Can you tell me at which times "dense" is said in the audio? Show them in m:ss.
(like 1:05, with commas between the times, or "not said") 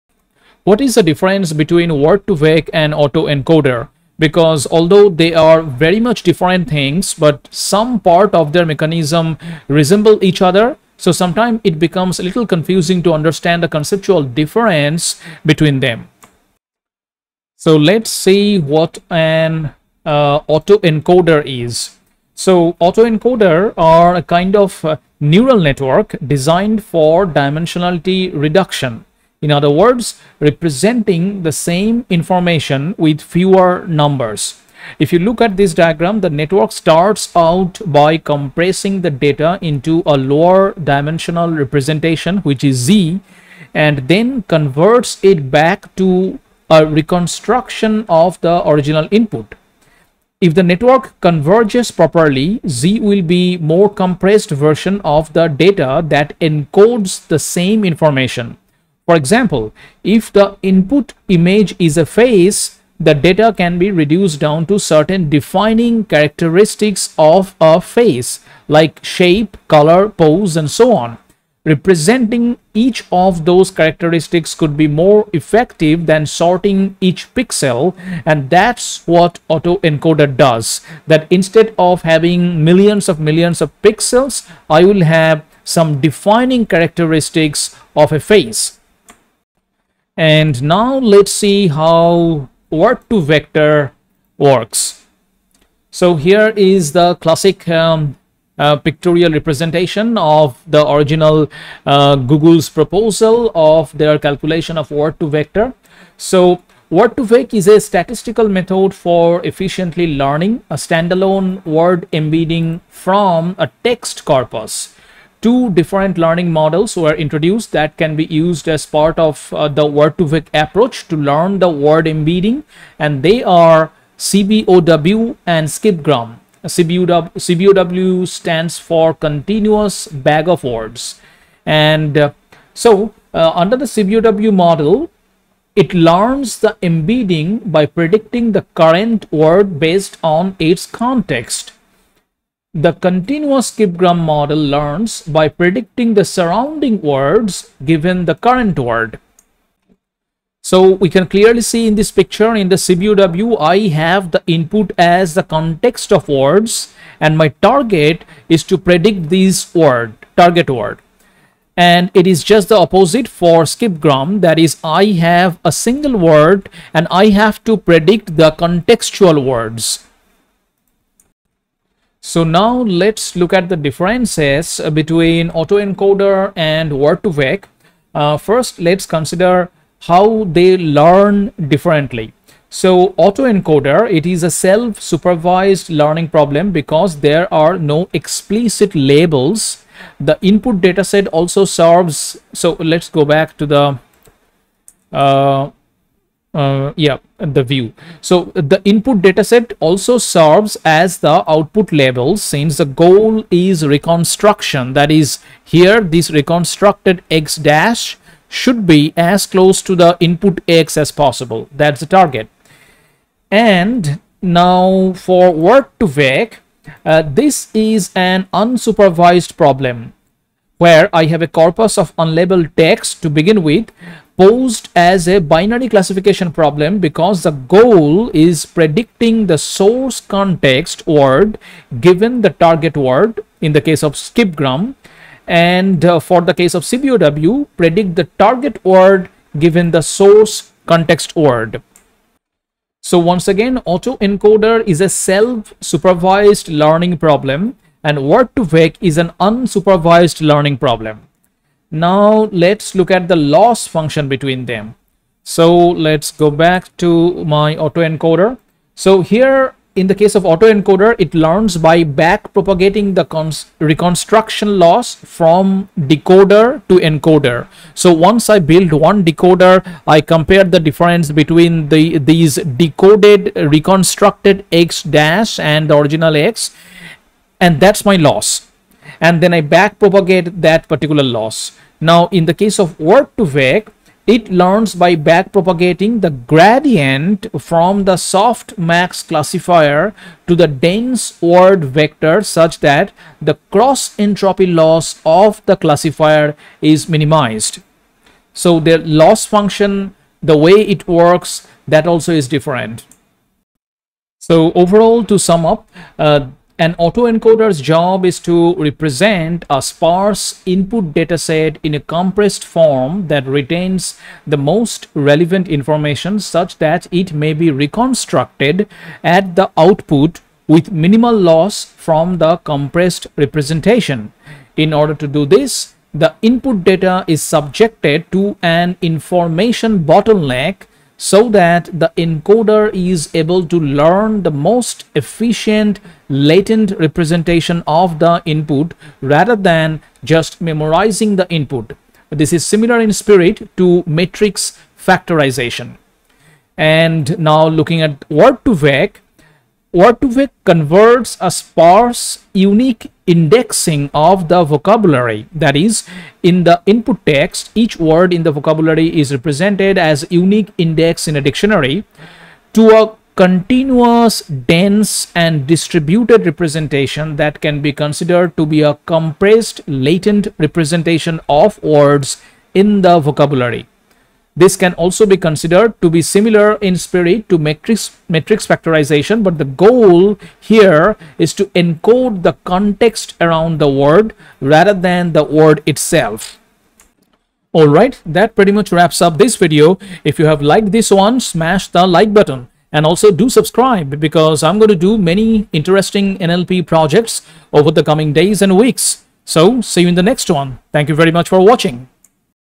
4:50, 6:04.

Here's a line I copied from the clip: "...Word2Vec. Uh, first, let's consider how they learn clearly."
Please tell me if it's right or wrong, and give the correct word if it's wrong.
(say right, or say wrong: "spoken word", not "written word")
wrong: "differently", not "clearly".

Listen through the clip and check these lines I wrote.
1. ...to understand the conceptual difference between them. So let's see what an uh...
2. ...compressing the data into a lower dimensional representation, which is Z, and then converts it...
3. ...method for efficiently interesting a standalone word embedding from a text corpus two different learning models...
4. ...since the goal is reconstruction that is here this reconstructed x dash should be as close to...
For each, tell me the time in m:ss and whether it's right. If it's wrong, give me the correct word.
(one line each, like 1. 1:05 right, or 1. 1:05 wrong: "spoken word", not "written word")
1. 0:13 right
2. 0:38 right
3. 1:48 wrong: "learning", not "interesting"
4. 3:22 right.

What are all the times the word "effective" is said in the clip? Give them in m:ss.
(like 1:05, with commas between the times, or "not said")
1:15.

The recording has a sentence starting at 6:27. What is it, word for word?
Alright, that pretty much wraps up this video.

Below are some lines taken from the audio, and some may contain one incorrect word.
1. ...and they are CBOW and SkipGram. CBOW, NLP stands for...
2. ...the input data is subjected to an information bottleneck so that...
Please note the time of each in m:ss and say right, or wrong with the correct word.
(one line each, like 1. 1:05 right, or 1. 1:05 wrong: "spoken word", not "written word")
1. 2:02 wrong: "CBOW", not "NLP"
2. 5:26 right.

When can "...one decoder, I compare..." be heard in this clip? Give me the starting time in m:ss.
4:28.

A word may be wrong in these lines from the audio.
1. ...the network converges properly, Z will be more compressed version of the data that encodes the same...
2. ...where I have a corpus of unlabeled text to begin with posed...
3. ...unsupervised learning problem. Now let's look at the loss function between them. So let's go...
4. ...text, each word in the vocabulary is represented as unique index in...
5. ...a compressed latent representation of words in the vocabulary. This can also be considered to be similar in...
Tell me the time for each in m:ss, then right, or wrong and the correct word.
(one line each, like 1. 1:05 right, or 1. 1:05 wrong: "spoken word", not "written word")
1. 0:50 right
2. 3:40 right
3. 4:09 right
4. 5:57 right
5. 6:08 right.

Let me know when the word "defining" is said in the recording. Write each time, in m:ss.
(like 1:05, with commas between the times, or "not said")
1:05, 1:26.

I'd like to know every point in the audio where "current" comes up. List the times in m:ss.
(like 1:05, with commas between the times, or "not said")
2:18, 2:28.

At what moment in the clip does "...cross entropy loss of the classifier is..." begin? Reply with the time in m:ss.
4:53.